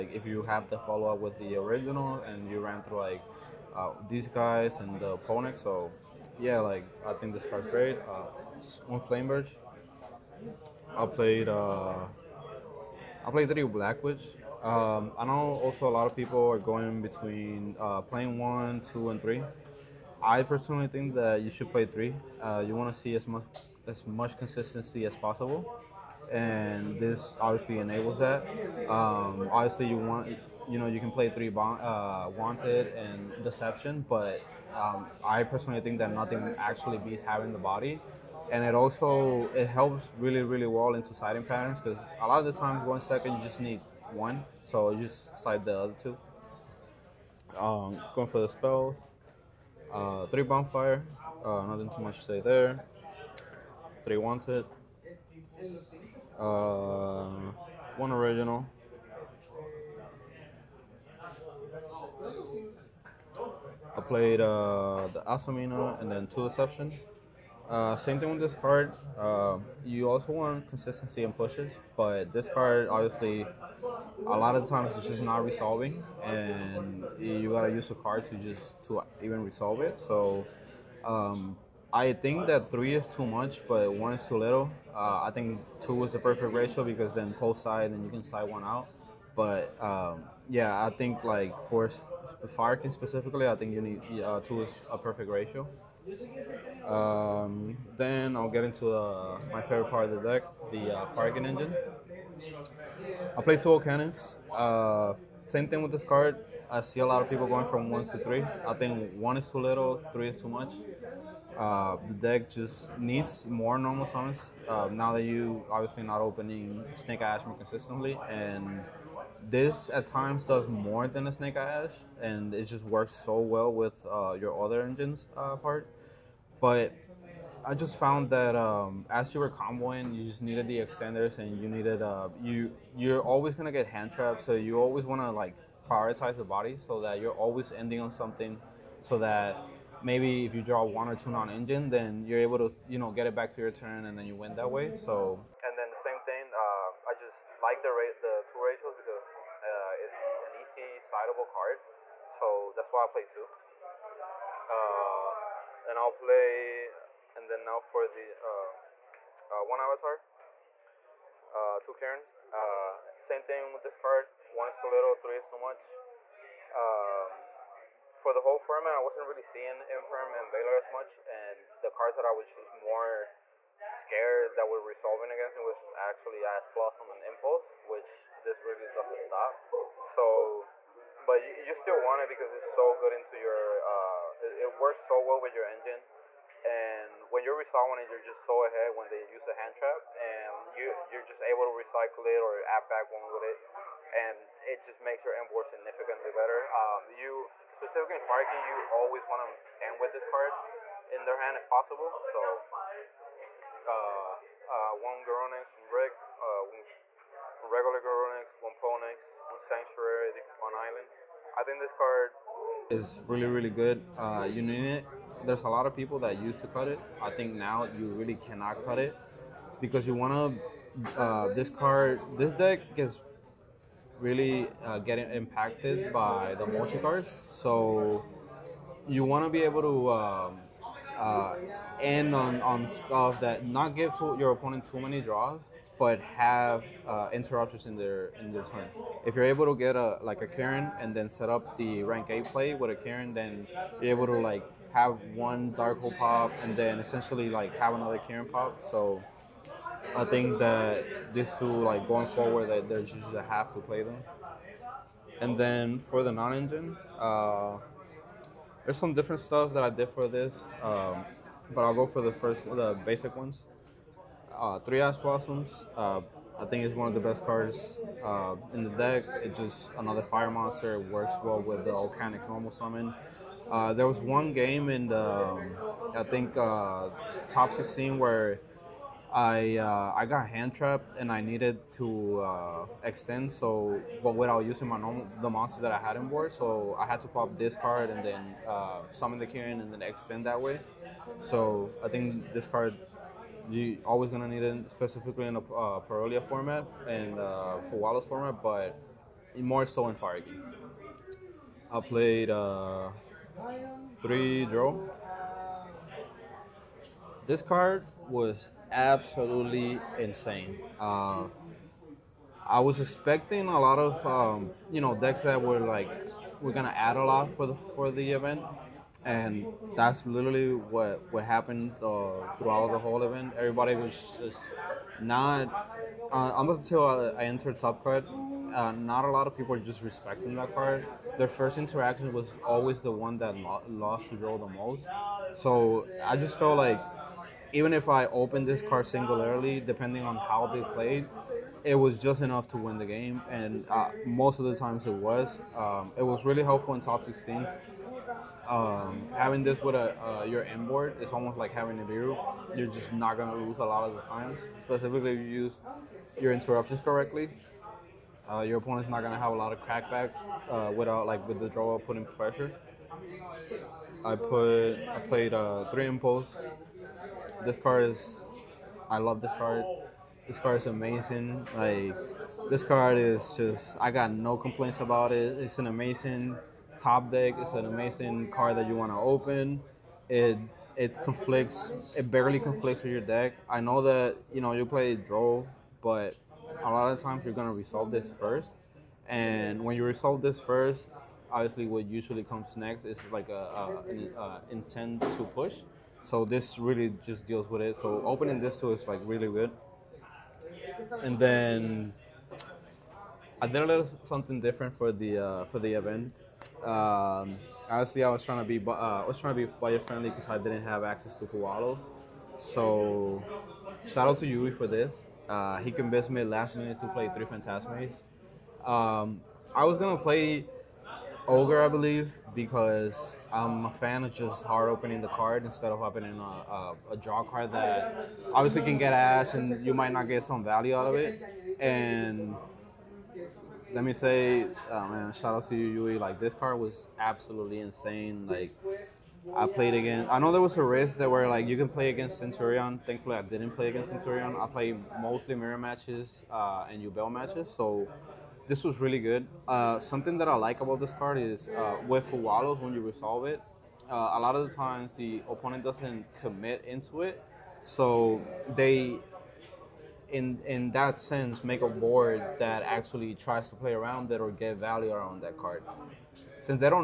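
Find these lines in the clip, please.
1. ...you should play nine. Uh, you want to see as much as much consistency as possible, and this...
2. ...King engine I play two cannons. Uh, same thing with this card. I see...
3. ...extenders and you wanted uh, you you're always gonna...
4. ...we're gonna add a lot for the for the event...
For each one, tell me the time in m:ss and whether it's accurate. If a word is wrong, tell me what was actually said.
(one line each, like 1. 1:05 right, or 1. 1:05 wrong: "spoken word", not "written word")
1. 0:21 wrong: "three", not "nine"
2. 1:41 right
3. 2:10 wrong: "needed", not "wanted"
4. 5:16 right.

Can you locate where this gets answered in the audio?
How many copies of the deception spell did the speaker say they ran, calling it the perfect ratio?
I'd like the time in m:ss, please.
1:06.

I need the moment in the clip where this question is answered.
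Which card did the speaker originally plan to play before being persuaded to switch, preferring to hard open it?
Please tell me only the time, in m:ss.
7:01.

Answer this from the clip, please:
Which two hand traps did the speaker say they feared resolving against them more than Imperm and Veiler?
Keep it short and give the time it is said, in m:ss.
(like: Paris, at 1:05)
Ash Blossom and Impulse, at 2:56.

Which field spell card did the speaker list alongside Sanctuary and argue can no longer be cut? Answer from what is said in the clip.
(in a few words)
Island.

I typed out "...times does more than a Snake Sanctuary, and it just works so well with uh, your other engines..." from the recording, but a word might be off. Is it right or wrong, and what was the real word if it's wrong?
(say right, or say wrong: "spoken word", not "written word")
wrong: "Ash", not "Sanctuary".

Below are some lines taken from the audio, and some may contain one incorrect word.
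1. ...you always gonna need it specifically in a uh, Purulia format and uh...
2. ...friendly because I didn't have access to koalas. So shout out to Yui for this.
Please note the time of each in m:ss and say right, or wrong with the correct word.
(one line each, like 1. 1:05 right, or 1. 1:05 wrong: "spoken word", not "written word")
1. 4:53 right
2. 6:49 right.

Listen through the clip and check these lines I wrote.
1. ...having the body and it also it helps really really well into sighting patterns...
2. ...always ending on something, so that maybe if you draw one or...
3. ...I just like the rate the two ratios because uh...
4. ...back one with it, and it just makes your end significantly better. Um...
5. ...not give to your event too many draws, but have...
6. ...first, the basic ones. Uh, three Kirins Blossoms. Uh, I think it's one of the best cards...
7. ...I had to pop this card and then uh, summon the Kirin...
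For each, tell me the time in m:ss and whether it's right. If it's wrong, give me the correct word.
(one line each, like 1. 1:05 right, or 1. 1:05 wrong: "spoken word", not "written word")
1. 0:37 right
2. 2:17 right
3. 2:27 right
4. 3:12 right
5. 3:53 wrong: "opponent", not "event"
6. 4:22 wrong: "Ash", not "Kirins"
7. 4:46 right.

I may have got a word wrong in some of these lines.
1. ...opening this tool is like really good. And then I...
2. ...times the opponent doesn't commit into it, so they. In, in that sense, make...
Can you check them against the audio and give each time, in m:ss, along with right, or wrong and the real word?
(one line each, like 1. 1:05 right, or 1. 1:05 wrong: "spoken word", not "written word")
1. 6:38 right
2. 7:34 right.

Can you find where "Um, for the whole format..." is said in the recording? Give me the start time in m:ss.
2:46.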